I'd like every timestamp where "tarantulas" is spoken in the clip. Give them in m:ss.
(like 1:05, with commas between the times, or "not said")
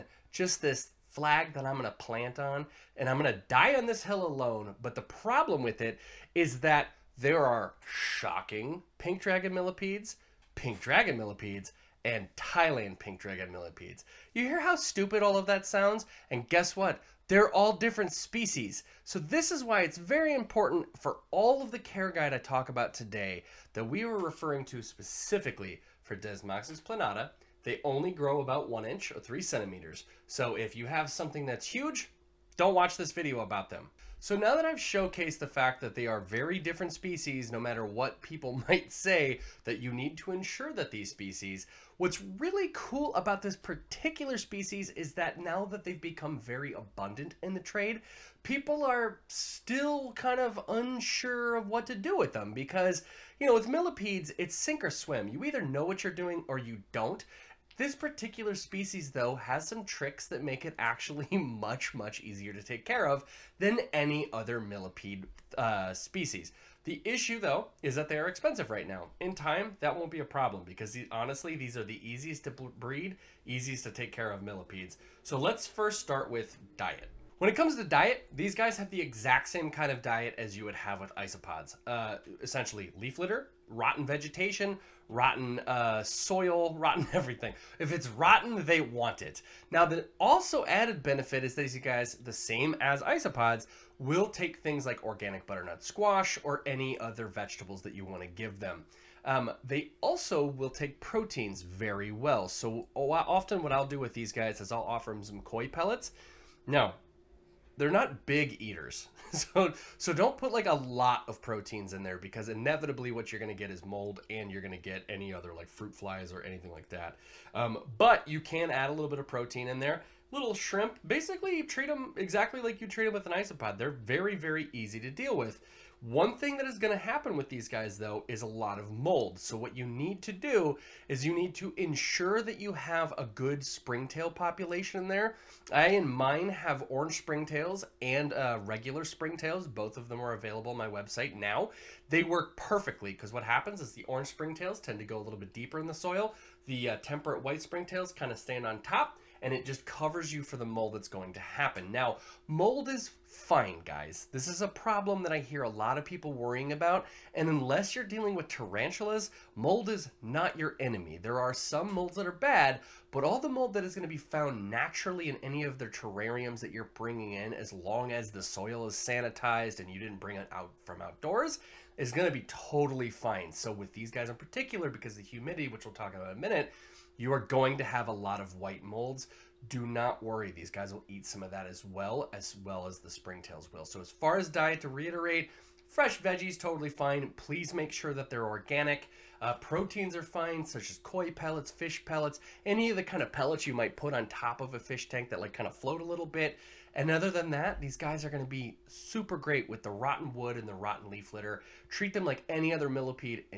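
2:38.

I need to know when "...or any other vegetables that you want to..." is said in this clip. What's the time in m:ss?
1:36.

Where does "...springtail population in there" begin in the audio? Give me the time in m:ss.
2:13.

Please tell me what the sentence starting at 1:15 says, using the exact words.
So let's first start with diet.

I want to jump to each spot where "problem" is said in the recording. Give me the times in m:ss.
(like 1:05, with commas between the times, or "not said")
0:05, 1:10, 2:34.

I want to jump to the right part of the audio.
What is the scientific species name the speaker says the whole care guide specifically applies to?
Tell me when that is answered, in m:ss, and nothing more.
0:26.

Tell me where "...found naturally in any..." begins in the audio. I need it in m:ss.
2:44.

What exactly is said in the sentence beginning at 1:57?
Um, but you can add a little bit of protein in there.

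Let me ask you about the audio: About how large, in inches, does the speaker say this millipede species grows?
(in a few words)
1 inch.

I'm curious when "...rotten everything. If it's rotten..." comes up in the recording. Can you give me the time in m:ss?
1:26.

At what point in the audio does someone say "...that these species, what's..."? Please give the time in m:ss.
0:40.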